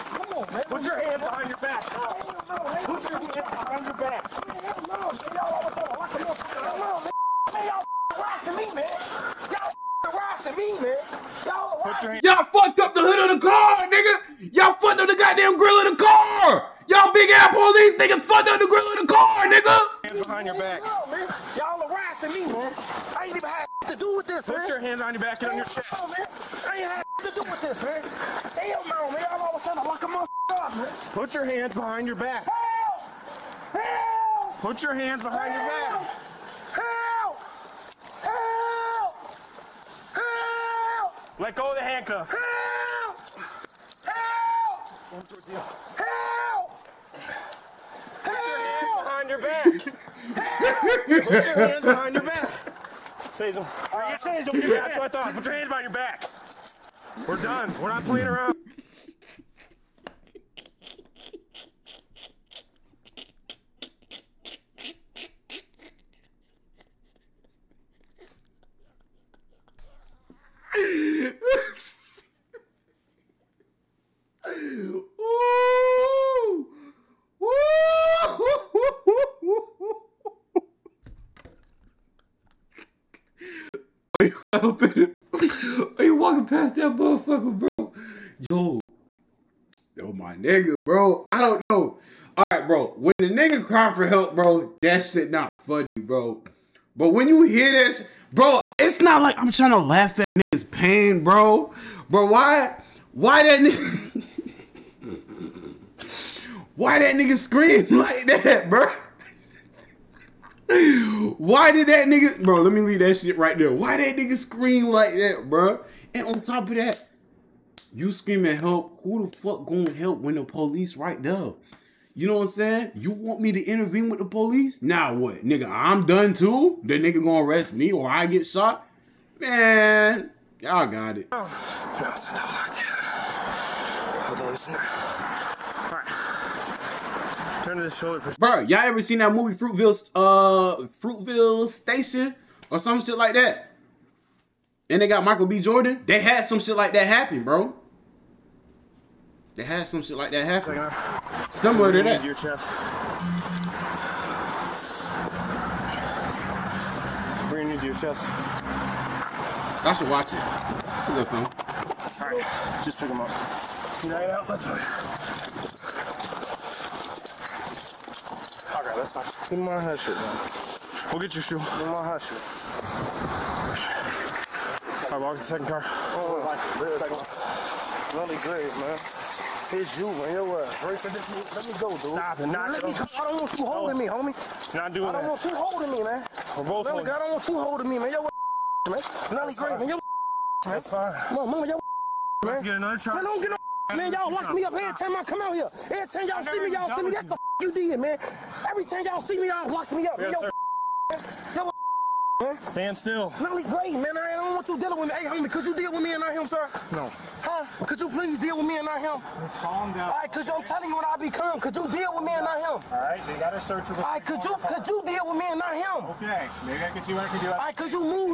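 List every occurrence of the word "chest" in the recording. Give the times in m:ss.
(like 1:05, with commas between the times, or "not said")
0:25, 2:32, 2:37.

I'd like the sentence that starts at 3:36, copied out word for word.
Okay, maybe I can see what I can do.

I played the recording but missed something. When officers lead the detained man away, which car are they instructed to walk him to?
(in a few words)
the second car.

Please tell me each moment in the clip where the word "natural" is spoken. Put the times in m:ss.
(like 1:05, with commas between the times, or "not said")
not said.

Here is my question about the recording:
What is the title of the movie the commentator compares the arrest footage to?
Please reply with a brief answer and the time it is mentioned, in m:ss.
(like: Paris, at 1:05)
Fruitvale Station, at 2:21.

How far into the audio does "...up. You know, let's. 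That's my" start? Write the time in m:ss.
2:43.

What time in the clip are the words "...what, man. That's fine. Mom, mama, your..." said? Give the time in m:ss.
3:09.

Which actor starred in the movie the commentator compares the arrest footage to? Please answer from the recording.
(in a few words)
Michael B. Jordan.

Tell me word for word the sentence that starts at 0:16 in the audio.
Y'all big ass police nigga, fucked up the grill of the car, nigga.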